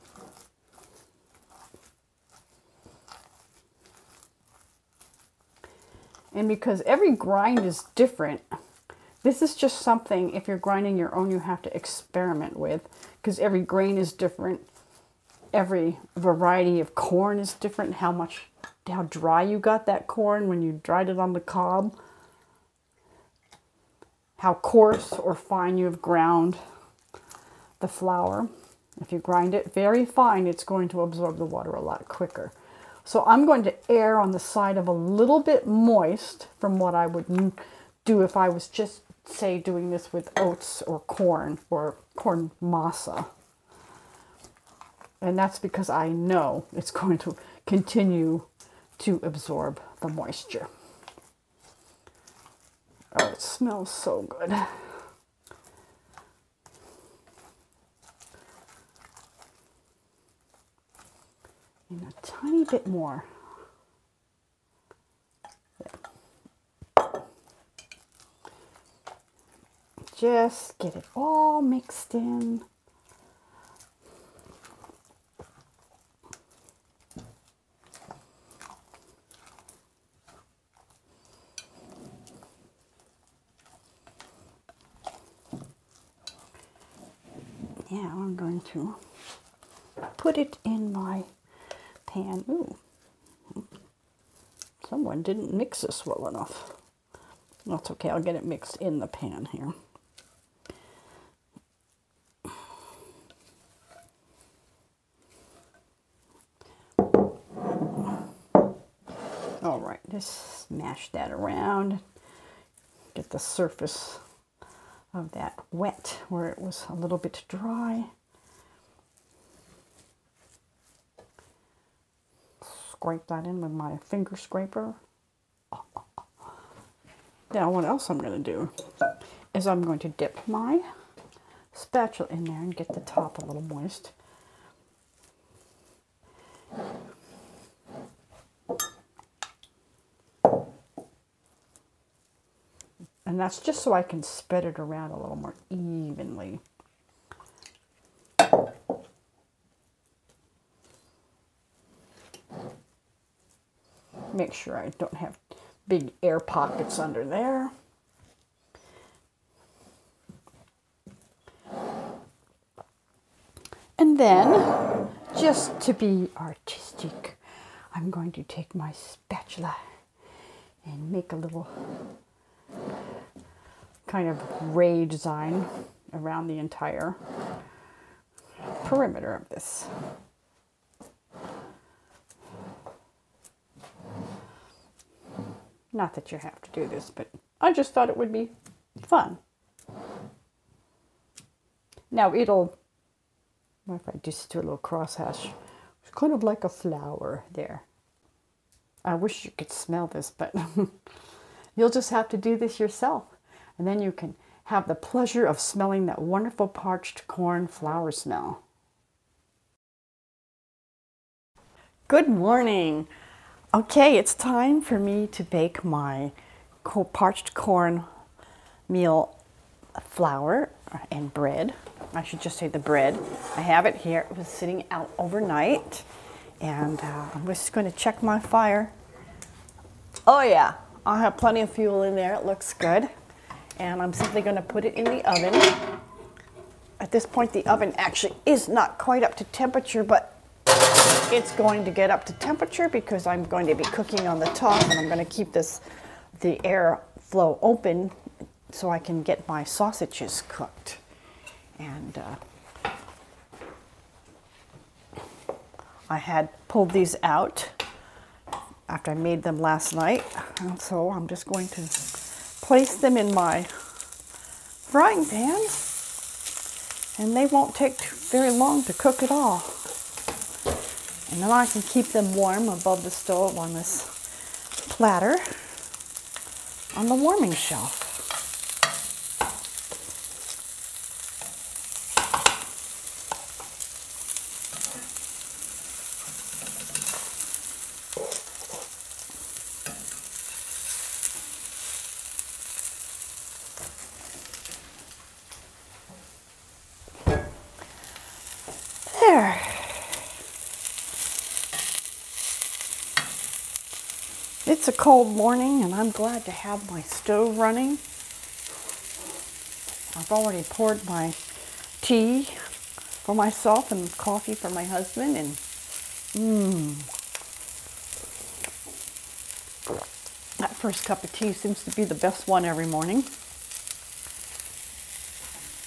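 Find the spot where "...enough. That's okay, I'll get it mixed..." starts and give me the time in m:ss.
1:36.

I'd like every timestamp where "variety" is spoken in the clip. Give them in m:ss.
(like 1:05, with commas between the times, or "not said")
0:16.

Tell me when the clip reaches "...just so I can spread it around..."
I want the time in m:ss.
2:23.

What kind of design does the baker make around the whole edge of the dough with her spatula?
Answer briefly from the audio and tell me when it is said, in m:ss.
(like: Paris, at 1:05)
ray design, at 2:54.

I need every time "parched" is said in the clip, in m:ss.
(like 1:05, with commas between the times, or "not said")
3:26, 3:37.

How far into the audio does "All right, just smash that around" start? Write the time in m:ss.
1:49.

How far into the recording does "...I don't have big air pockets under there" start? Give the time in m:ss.
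2:34.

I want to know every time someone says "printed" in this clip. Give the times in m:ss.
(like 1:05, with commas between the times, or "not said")
not said.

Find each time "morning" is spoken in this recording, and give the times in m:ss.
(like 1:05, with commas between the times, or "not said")
3:32, 5:05, 5:22.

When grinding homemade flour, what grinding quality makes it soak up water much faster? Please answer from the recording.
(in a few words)
very fine.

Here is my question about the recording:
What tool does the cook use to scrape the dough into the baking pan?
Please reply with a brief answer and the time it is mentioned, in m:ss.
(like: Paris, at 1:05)
finger scraper, at 2:03.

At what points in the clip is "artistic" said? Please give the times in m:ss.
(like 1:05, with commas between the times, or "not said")
2:46.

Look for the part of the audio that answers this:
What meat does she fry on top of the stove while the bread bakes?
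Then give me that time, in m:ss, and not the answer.
4:09.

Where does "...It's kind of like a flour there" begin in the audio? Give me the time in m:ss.
3:15.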